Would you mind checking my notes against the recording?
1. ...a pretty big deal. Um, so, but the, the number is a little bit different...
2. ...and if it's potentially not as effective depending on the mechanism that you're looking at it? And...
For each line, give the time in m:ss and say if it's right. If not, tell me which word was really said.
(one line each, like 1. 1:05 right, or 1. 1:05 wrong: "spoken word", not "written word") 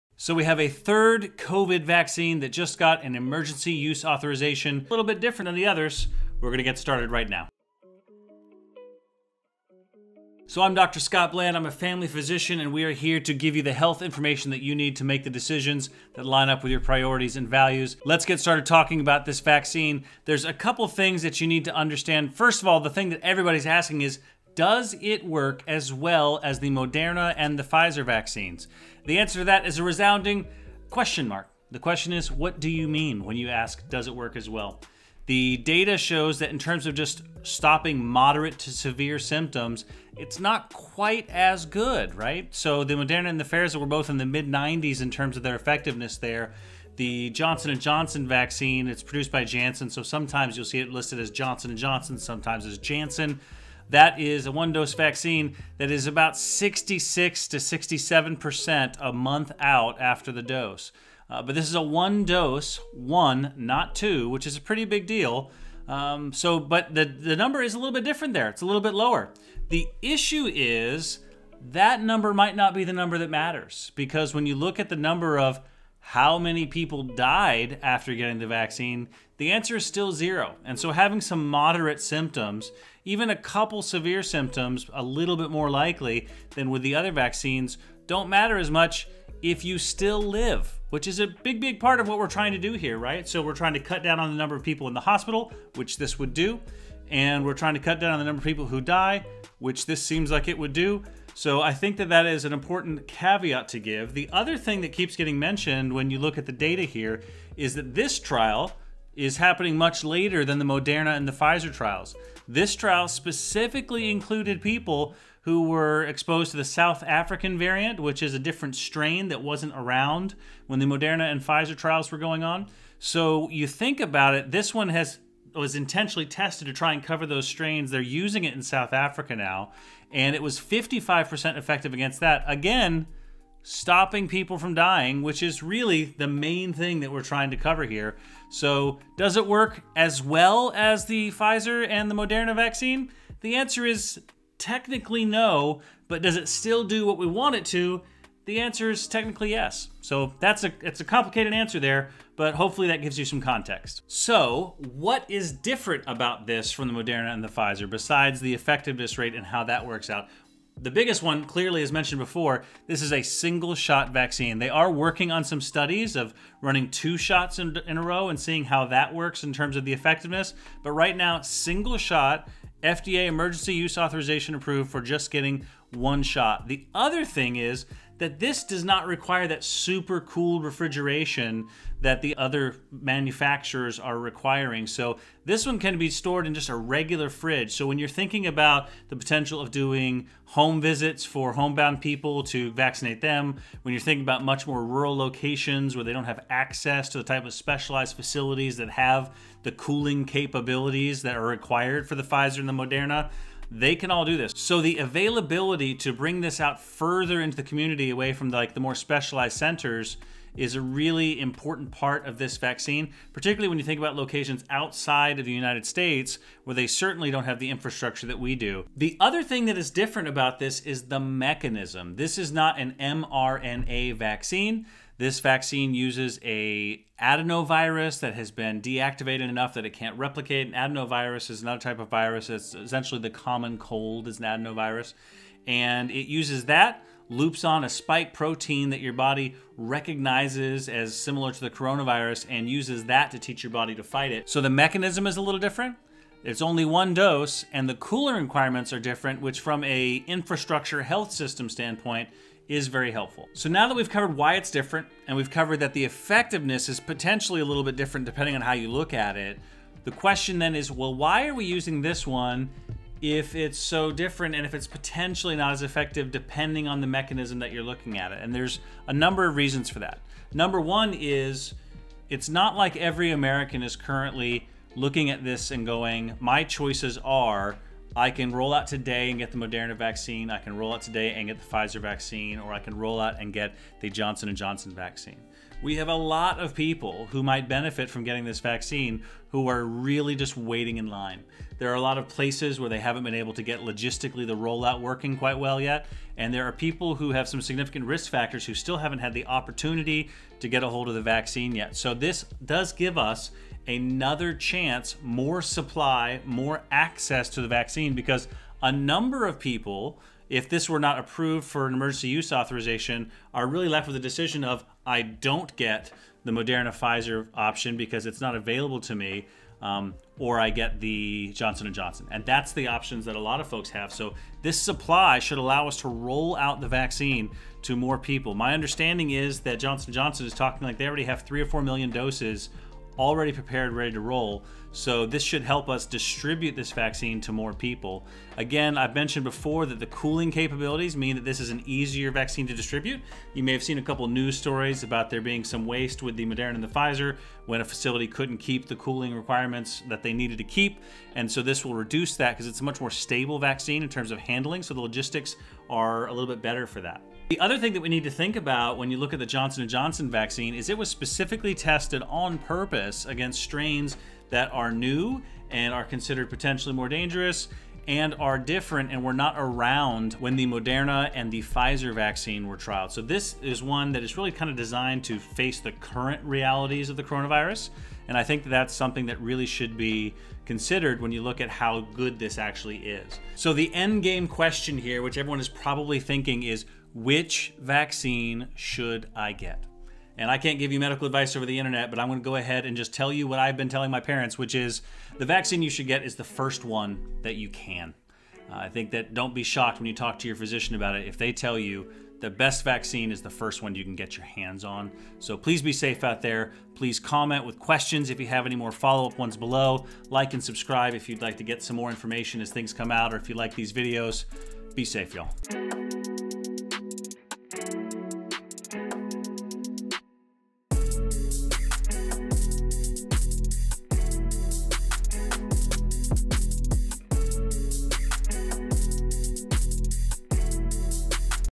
1. 1:04 right
2. 4:24 right.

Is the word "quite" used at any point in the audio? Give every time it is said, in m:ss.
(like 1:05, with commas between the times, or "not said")
0:40, 4:55.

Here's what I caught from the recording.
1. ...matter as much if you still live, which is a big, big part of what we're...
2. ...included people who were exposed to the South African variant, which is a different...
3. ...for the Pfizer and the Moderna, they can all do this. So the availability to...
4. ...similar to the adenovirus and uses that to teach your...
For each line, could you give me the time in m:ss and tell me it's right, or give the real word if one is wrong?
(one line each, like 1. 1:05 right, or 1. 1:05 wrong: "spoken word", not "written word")
1. 1:28 right
2. 1:54 right
3. 3:22 right
4. 4:01 wrong: "coronavirus", not "adenovirus".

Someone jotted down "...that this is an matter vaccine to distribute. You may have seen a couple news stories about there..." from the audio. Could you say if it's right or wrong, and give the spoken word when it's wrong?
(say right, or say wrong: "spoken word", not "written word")
wrong: "easier", not "matter".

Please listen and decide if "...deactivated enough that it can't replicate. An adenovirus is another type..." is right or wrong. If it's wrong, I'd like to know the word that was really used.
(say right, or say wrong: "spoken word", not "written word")
right.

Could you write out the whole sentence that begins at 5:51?
And so this will reduce that because it's a much more stable vaccine in terms of handling.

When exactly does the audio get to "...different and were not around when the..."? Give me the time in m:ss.
6:08.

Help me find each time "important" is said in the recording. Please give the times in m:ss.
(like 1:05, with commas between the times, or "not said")
1:42, 3:31.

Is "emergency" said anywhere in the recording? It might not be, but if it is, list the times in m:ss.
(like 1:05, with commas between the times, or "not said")
0:03, 2:53, 5:11.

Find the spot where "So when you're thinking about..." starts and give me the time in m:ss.
3:07.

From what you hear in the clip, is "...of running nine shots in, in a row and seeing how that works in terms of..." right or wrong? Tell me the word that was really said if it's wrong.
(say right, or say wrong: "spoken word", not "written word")
wrong: "two", not "nine".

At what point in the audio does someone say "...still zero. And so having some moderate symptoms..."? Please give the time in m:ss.
1:19.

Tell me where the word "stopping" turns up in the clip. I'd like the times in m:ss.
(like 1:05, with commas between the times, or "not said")
0:37, 2:13.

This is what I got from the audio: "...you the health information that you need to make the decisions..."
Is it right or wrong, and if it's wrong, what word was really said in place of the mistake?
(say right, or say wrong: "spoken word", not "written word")
right.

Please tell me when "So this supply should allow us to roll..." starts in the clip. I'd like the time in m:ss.
5:24.